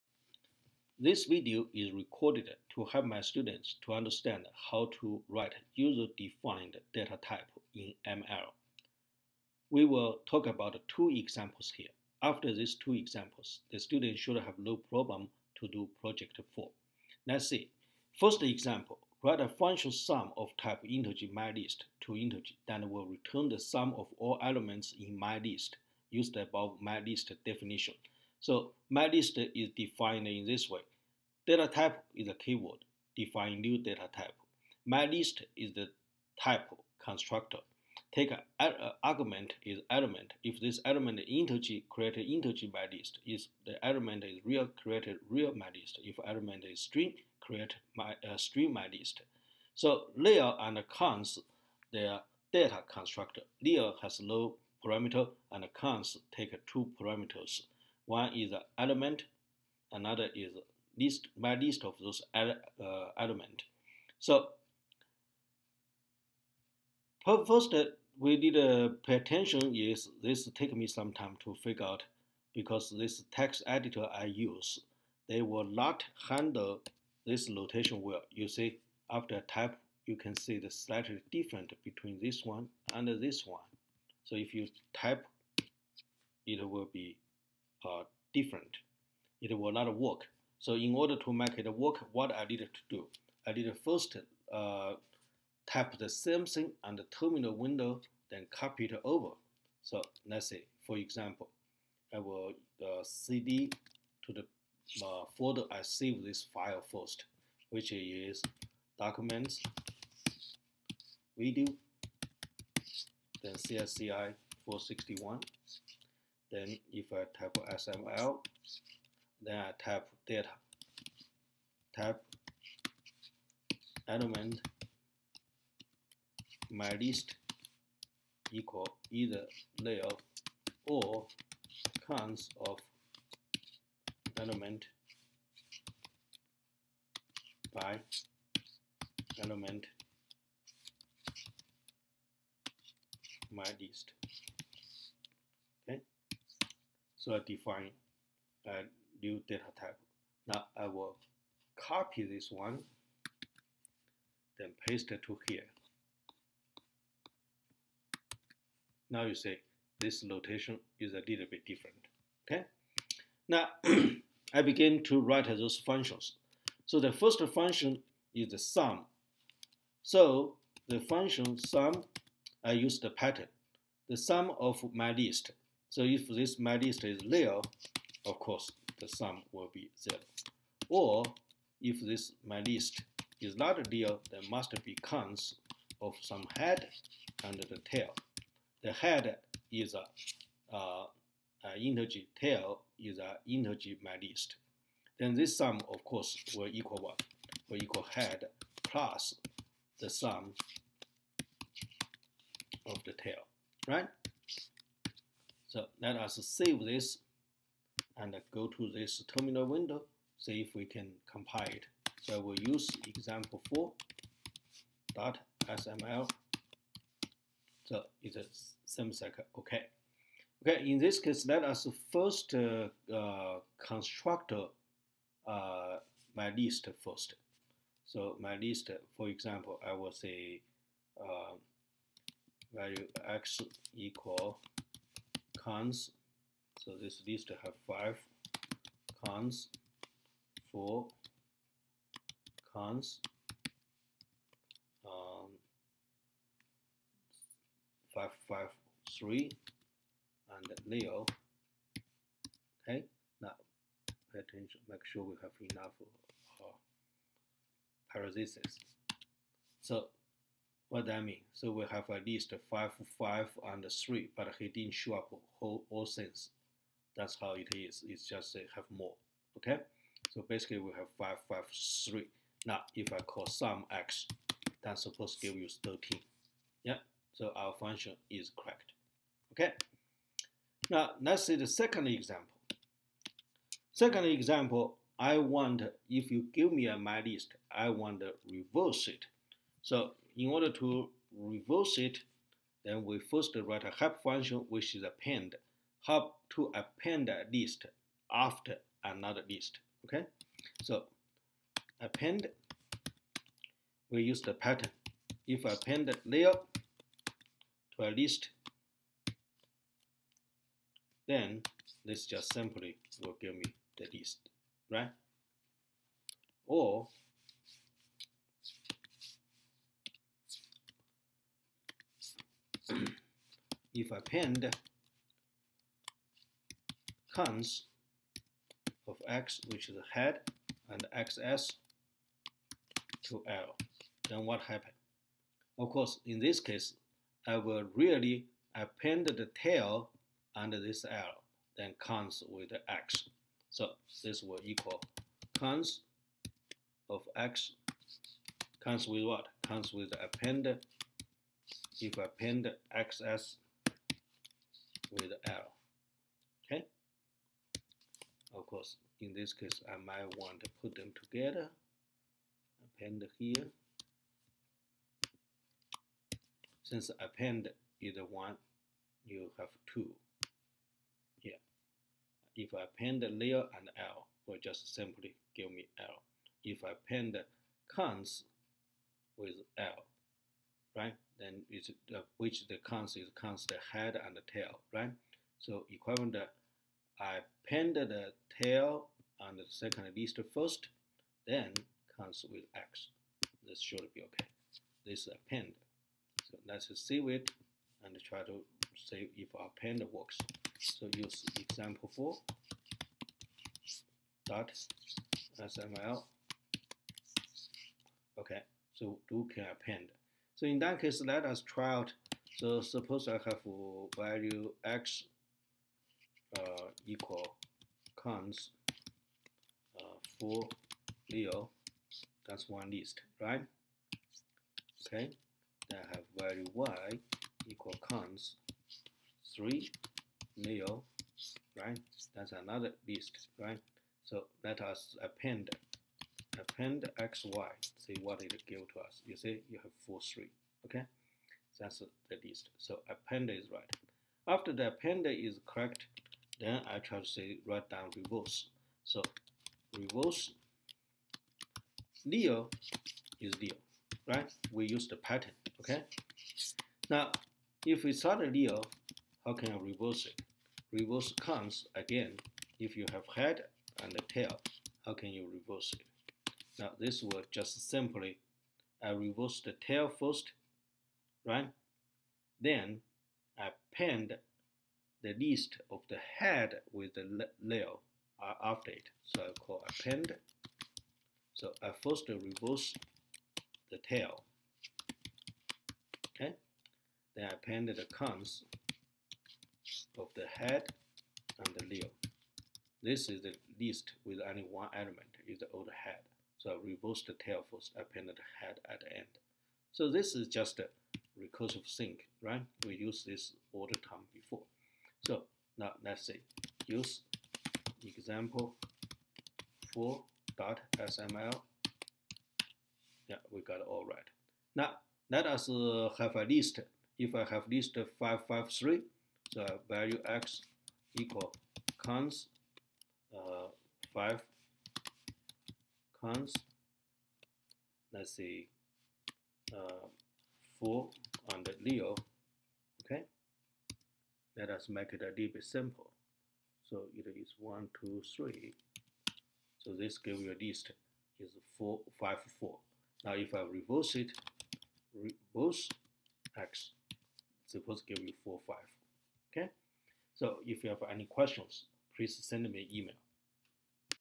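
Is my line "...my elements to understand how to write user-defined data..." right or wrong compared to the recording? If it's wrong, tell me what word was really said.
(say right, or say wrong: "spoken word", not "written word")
wrong: "students", not "elements".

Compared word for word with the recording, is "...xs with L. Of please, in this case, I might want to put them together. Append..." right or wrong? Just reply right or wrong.
wrong.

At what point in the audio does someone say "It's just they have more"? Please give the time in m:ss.
4:28.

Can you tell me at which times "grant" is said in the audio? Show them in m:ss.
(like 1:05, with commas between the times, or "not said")
not said.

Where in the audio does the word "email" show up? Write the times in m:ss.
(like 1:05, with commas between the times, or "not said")
9:12.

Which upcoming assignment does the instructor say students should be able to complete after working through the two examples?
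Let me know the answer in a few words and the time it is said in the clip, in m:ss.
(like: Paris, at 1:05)
Project 4, at 0:16.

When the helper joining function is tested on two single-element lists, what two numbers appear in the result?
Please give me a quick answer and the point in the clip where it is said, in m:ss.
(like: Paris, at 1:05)
4, 3, at 7:20.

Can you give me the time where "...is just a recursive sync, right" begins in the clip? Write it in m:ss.
8:20.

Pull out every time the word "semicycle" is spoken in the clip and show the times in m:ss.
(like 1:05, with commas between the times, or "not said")
3:38.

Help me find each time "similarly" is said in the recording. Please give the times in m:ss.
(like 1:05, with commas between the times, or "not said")
not said.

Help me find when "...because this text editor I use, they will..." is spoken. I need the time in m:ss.
1:12.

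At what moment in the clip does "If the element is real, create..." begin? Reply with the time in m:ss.
0:43.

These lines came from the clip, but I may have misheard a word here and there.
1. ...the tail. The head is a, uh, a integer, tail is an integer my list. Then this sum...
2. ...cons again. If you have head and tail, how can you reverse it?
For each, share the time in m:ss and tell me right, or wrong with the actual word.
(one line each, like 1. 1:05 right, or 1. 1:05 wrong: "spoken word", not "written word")
1. 3:07 right
2. 7:41 right.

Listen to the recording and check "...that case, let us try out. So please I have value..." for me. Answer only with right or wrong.
wrong.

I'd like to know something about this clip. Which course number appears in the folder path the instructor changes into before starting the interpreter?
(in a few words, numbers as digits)
CSCI 461.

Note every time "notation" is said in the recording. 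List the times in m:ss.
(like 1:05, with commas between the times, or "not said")
1:17, 2:40.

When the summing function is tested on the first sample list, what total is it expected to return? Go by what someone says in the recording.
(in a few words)
13.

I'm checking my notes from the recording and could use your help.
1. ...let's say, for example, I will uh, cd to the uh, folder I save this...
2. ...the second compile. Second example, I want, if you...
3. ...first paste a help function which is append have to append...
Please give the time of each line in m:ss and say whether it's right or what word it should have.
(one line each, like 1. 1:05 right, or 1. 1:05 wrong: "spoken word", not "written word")
1. 1:40 right
2. 4:41 wrong: "example", not "compile"
3. 4:53 wrong: "write", not "paste".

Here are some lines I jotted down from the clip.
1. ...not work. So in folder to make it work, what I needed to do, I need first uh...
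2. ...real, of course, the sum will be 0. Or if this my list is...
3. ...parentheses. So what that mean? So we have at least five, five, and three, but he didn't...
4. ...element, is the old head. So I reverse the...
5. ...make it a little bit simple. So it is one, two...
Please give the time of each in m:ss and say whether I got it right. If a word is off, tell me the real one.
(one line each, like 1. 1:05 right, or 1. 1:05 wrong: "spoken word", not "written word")
1. 1:29 wrong: "order", not "folder"
2. 2:57 right
3. 4:18 right
4. 8:14 right
5. 8:54 right.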